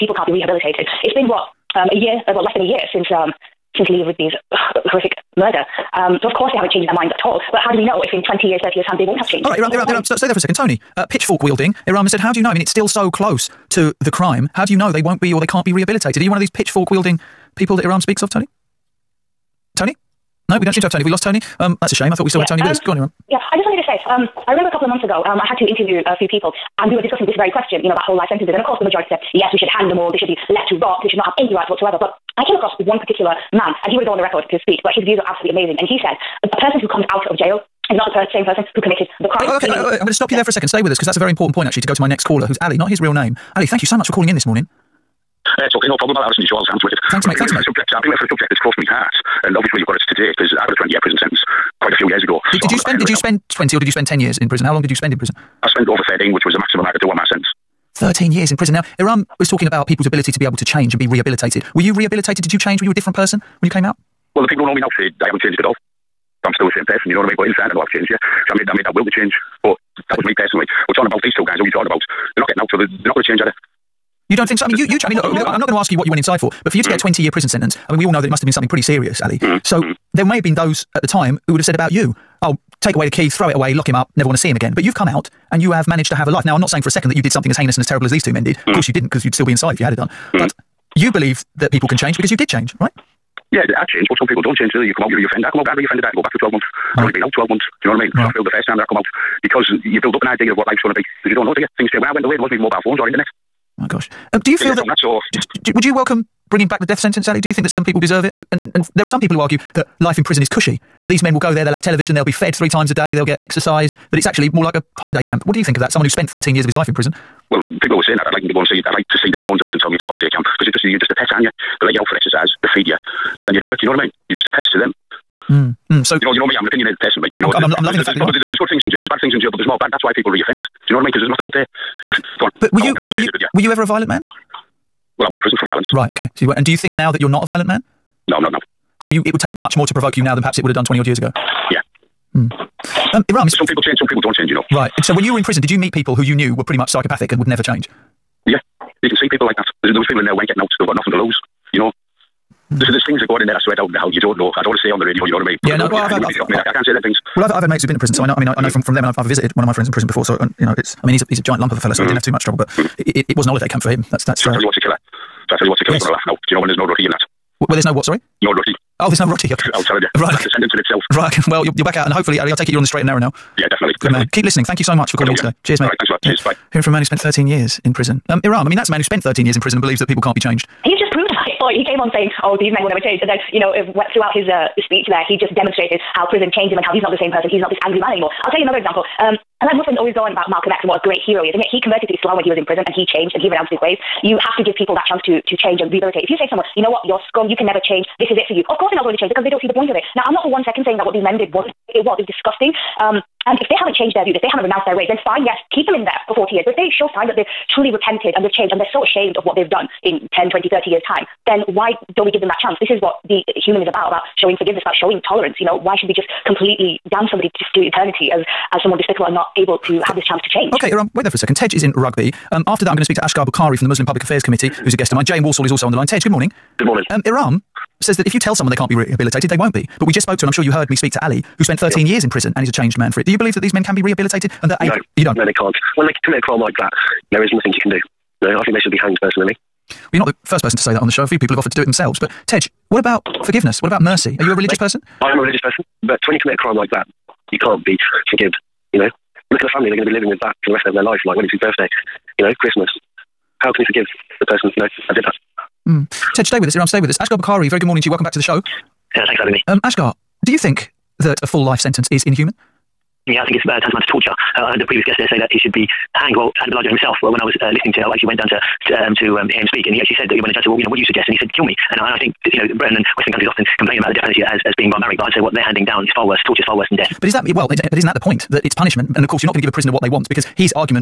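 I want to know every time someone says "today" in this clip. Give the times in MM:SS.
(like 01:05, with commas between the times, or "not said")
00:50, 02:55.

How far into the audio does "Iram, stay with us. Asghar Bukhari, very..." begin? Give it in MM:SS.
04:16.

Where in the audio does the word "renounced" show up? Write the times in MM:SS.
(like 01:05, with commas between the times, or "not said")
03:13, 03:24.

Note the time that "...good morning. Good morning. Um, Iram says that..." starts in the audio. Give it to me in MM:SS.
03:46.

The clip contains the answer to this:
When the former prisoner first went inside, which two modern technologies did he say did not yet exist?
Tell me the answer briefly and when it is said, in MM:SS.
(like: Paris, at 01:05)
mobile phones or internet, at 01:42.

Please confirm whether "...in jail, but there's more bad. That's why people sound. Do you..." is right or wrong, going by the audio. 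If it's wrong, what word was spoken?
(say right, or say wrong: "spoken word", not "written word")
wrong: "reoffend", not "sound".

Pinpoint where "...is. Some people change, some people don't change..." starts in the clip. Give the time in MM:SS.
02:23.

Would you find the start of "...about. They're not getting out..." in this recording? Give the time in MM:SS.
01:11.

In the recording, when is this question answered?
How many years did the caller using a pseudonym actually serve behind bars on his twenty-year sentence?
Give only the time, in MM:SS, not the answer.
00:55.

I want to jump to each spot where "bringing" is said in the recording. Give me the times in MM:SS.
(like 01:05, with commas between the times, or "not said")
01:46.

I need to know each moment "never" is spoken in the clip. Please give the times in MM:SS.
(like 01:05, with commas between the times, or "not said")
01:24, 02:27, 03:02, 03:17.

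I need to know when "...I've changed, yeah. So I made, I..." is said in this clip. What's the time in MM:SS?
01:07.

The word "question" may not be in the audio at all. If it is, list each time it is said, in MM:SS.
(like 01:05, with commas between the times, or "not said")
00:27.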